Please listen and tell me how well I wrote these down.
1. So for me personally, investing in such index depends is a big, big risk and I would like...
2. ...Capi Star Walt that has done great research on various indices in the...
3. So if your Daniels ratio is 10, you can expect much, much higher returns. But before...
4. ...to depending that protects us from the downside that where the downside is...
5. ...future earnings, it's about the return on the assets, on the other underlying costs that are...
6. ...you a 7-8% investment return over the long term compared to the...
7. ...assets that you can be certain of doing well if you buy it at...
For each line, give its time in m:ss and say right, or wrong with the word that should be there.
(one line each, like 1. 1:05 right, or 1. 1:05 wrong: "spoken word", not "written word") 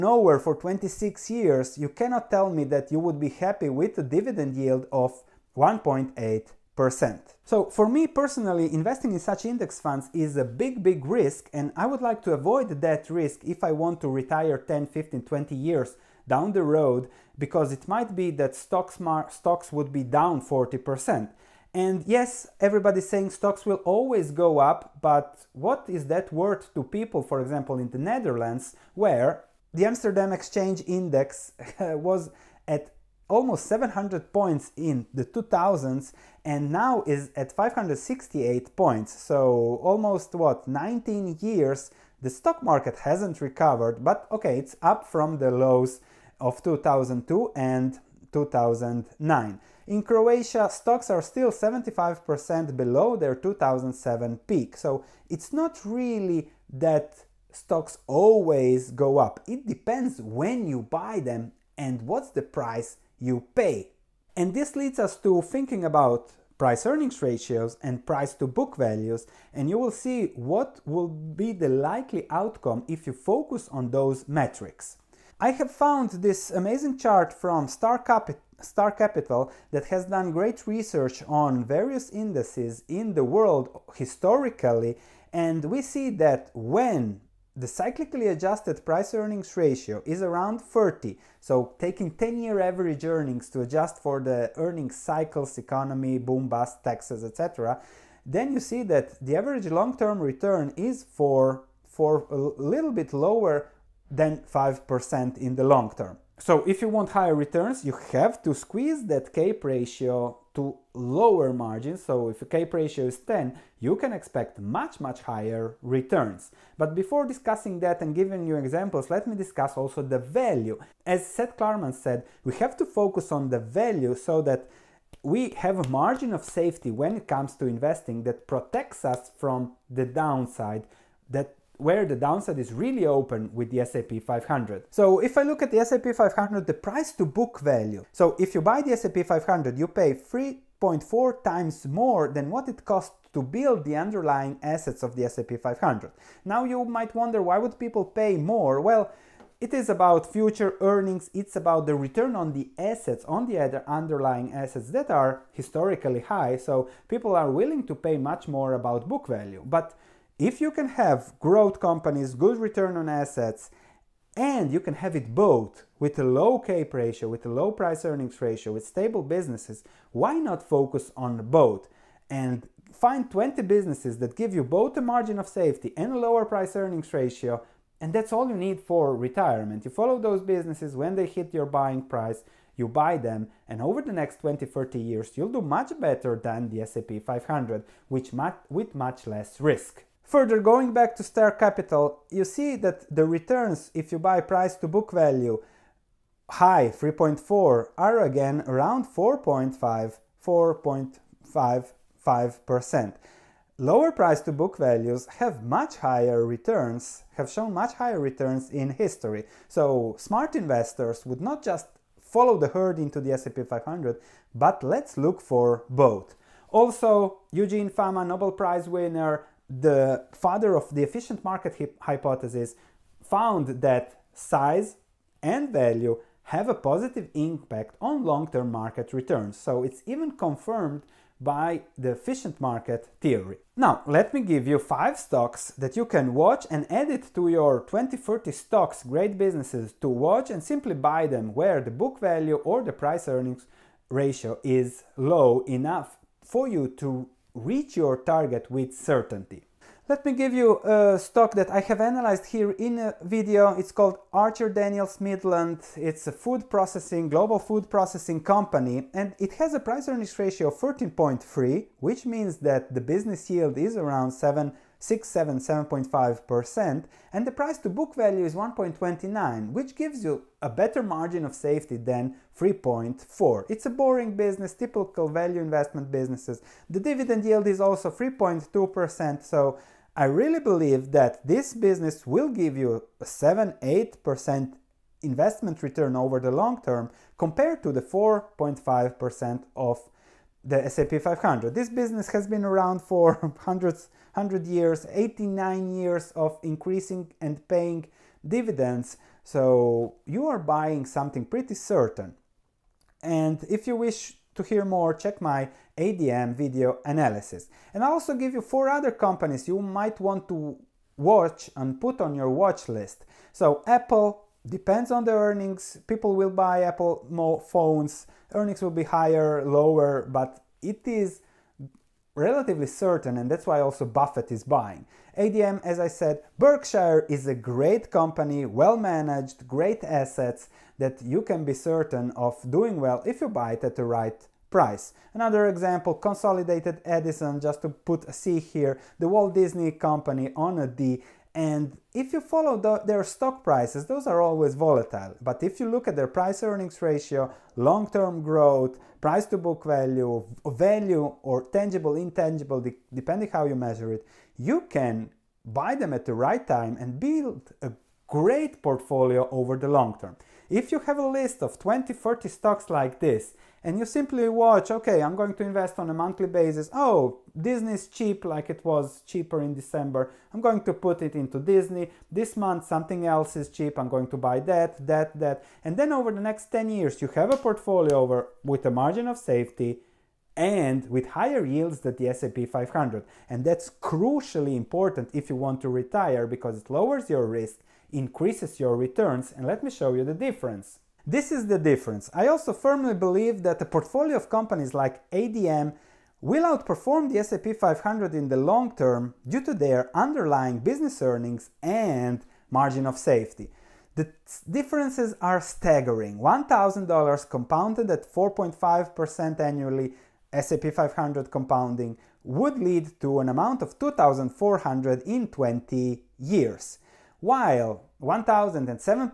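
1. 0:07 wrong: "funds", not "depends"
2. 1:17 wrong: "Capital", not "Walt"
3. 1:52 wrong: "CAPE", not "Daniels"
4. 2:07 wrong: "investing", not "depending"
5. 2:30 wrong: "assets", not "costs"
6. 4:42 right
7. 5:30 right.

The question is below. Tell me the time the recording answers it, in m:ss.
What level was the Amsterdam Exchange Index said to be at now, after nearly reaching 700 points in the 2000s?
0:37.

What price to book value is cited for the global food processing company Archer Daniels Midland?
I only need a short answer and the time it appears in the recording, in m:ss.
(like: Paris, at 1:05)
1.29, at 4:28.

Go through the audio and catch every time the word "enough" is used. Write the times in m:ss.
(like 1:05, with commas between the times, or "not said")
4:05.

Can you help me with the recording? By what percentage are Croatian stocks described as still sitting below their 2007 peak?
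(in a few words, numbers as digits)
75%.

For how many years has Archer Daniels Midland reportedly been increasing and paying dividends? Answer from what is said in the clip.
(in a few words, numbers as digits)
89 years.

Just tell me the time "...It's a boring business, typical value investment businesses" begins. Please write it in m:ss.
4:33.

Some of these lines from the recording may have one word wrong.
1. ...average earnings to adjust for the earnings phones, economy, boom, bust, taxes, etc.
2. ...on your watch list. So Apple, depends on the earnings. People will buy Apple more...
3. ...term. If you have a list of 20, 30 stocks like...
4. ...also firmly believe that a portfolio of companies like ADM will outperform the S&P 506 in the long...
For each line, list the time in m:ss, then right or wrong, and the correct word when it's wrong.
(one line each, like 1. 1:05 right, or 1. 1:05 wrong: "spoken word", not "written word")
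1. 1:32 wrong: "cycles", not "phones"
2. 5:12 right
3. 6:00 right
4. 6:32 wrong: "500", not "506".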